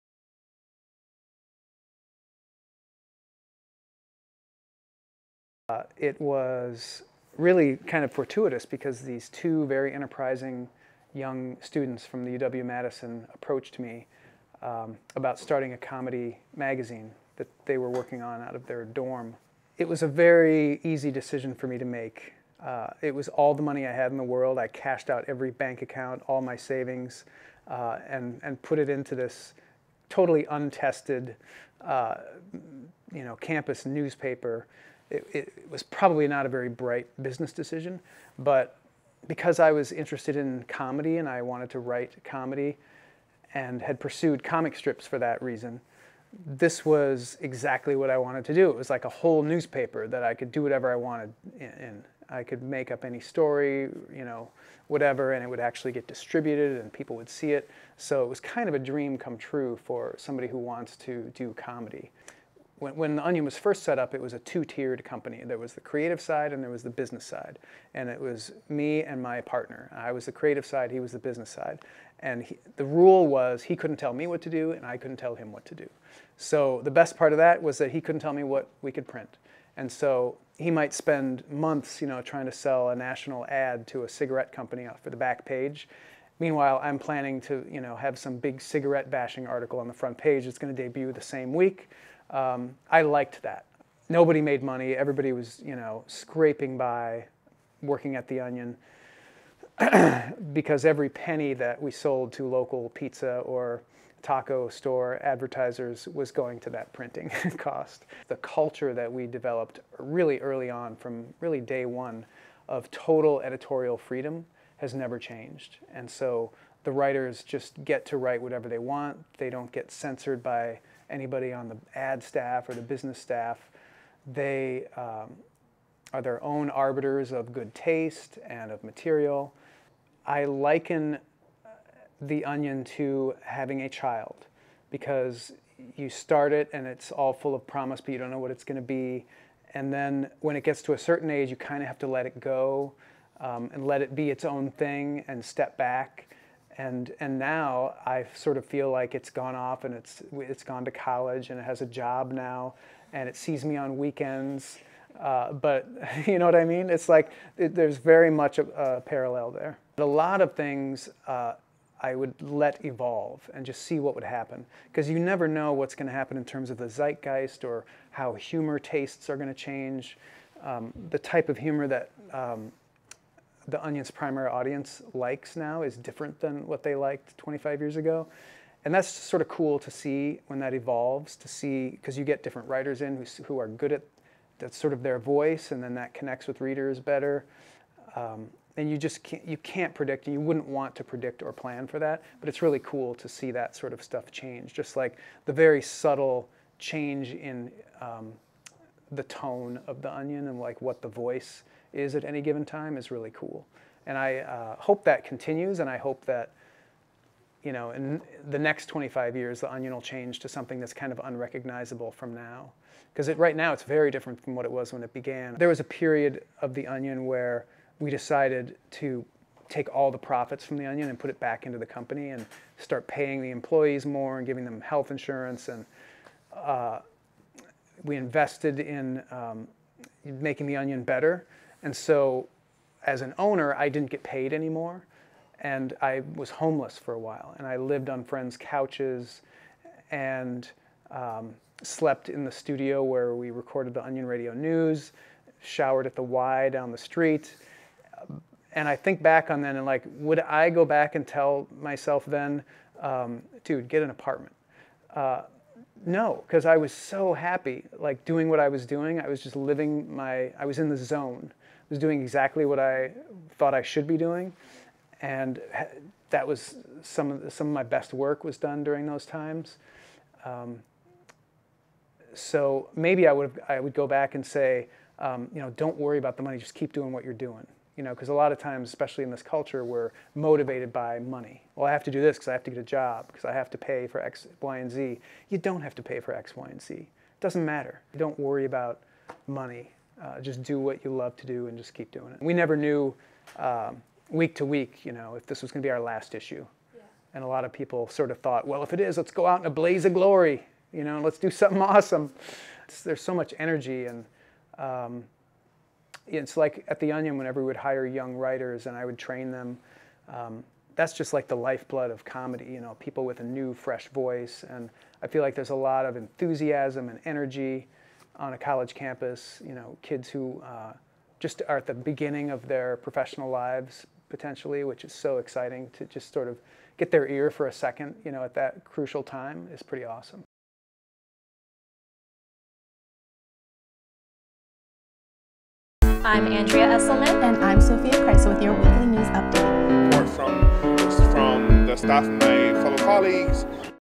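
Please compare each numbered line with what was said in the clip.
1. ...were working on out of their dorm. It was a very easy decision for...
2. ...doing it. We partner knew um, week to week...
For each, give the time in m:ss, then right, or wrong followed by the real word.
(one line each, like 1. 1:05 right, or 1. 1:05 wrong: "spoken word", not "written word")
1. 0:17 right
2. 4:52 wrong: "never", not "partner".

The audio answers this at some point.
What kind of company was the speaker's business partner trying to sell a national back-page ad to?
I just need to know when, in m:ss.
1:24.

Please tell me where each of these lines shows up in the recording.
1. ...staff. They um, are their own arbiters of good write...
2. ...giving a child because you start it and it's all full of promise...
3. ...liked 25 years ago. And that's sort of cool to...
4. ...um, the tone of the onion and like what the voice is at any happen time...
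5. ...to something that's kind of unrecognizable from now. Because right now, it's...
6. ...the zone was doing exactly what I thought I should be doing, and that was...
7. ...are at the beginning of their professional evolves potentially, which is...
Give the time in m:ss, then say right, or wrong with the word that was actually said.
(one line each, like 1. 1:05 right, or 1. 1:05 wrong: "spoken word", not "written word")
1. 2:03 wrong: "taste", not "write"
2. 2:13 wrong: "having", not "giving"
3. 2:56 right
4. 3:18 wrong: "given", not "happen"
5. 3:30 right
6. 4:20 right
7. 5:21 wrong: "lives", not "evolves".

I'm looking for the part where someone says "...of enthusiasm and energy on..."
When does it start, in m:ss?
5:16.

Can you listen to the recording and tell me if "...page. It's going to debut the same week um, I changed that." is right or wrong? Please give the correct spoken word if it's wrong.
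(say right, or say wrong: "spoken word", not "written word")
wrong: "liked", not "changed".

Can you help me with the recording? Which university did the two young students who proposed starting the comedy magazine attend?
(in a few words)
UW-Madison.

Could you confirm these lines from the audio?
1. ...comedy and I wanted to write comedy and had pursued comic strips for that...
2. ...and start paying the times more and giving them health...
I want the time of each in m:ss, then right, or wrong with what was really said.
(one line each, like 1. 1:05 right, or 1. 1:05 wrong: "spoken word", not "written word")
1. 0:40 right
2. 3:42 wrong: "employees", not "times".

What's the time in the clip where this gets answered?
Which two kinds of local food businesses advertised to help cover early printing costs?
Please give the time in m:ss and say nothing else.
1:42.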